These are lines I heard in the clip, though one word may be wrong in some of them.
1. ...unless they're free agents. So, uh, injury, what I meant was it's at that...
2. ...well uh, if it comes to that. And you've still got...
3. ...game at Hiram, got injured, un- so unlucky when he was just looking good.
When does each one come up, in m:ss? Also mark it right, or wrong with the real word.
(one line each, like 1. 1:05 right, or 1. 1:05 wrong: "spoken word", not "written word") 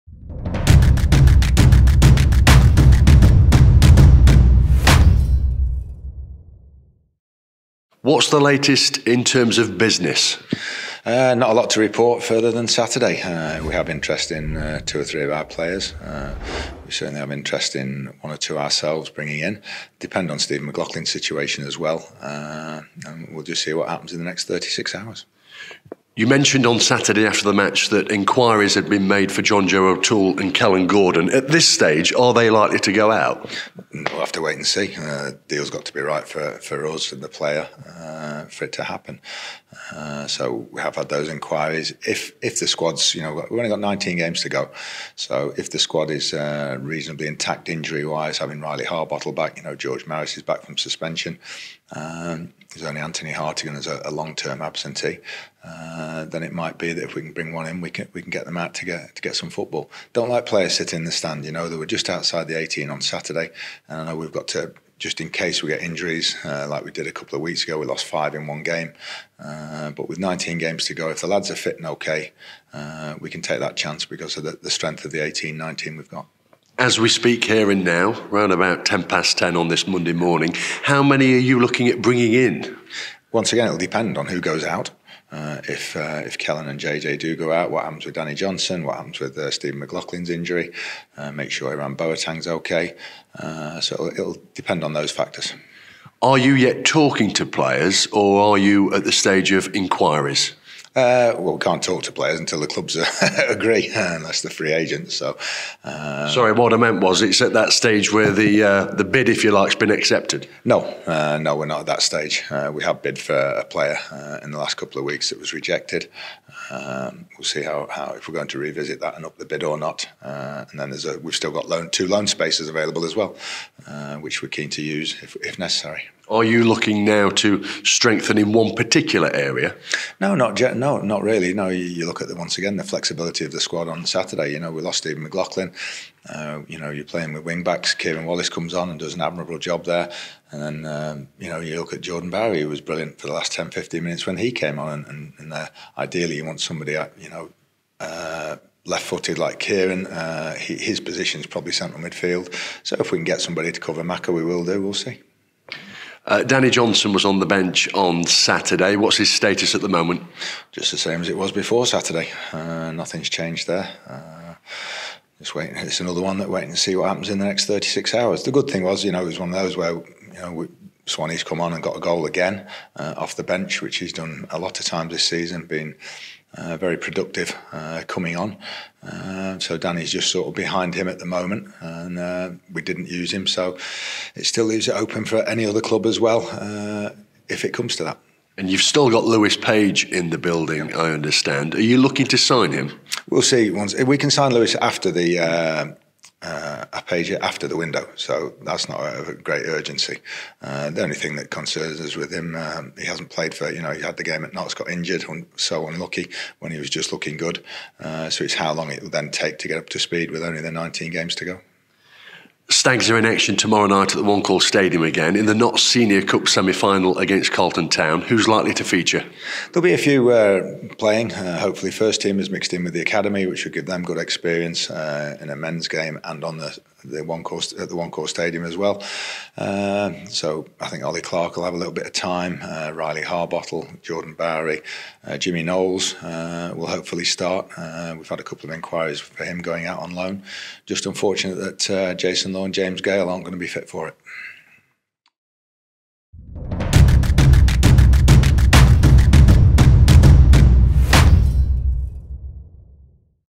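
1. 1:43 wrong: "sorry", not "injury"
2. 3:06 right
3. 3:24 wrong: "Notts", not "Hiram".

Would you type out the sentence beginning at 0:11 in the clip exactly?
Uh, not a lot to report further than Saturday.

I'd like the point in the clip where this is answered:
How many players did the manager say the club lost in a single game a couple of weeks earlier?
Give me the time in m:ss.
1:08.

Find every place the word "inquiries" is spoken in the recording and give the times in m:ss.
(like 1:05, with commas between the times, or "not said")
0:28, 0:41, 1:39, 3:58.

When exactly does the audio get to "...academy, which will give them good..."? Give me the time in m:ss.
3:43.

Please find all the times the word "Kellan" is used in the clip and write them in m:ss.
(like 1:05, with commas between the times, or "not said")
0:30, 1:26.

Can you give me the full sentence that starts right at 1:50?
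No, uh, no, we're not at that stage.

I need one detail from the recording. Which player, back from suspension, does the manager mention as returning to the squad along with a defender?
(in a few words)
George Maris.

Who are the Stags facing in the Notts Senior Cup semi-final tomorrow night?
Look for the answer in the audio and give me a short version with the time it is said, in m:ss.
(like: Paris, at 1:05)
Carlton Town, at 3:37.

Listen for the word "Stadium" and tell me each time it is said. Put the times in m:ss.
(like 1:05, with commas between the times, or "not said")
3:34, 3:48.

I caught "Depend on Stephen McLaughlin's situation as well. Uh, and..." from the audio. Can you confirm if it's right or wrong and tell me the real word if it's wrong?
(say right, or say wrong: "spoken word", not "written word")
right.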